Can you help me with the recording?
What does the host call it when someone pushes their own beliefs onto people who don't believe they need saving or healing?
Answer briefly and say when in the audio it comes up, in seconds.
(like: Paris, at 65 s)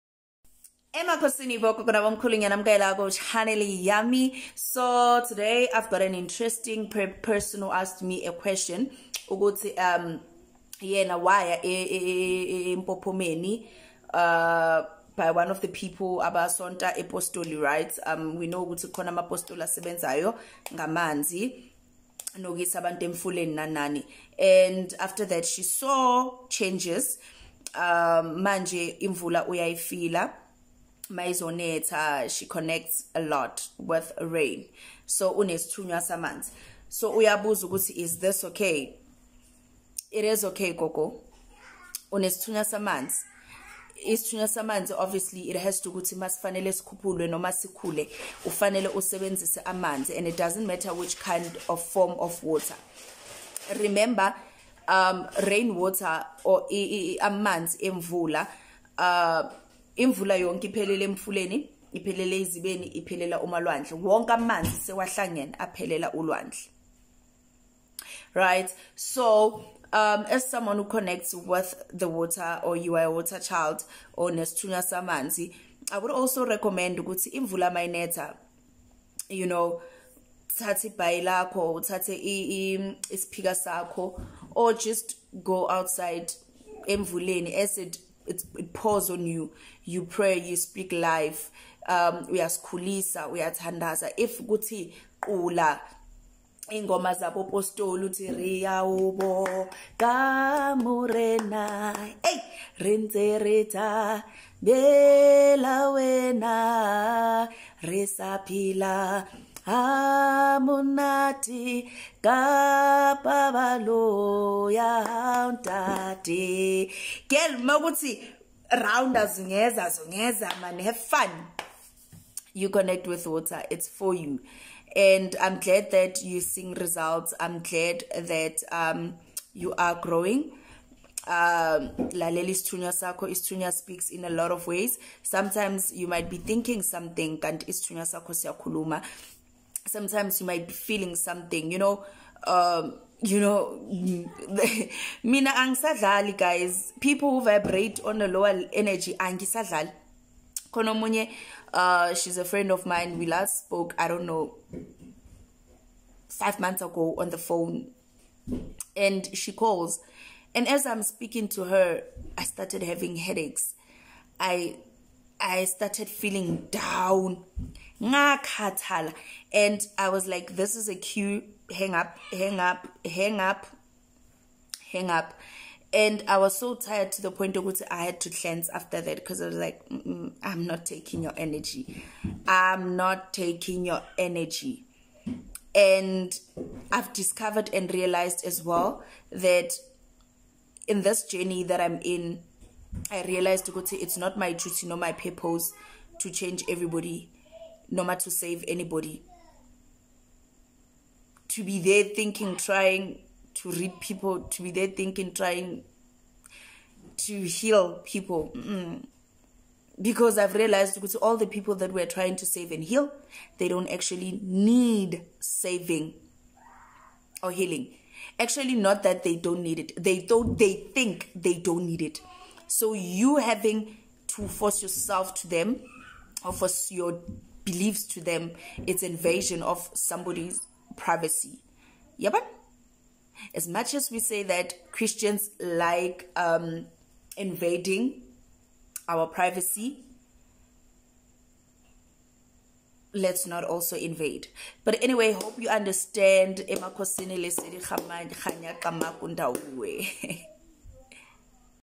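Invasion of somebody's privacy, at 229 s.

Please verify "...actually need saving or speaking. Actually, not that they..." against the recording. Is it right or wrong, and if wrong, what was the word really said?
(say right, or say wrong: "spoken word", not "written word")
wrong: "healing", not "speaking".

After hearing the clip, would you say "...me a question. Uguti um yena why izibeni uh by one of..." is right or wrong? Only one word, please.
wrong.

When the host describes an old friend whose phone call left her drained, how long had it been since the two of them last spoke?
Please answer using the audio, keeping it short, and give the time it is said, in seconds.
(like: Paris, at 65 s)
5 months, at 156 s.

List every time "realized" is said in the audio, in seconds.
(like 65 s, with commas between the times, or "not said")
187 s, 193 s, 210 s.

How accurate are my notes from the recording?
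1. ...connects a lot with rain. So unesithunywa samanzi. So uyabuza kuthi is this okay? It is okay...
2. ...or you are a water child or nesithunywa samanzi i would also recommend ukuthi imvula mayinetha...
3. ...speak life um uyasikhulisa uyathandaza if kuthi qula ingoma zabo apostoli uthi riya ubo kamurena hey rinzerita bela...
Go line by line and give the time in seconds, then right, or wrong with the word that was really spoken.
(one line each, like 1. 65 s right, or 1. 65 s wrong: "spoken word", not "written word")
1. 32 s wrong: "ukuthi", not "kuthi"
2. 72 s right
3. 90 s right.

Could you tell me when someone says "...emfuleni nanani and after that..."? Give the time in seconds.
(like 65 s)
23 s.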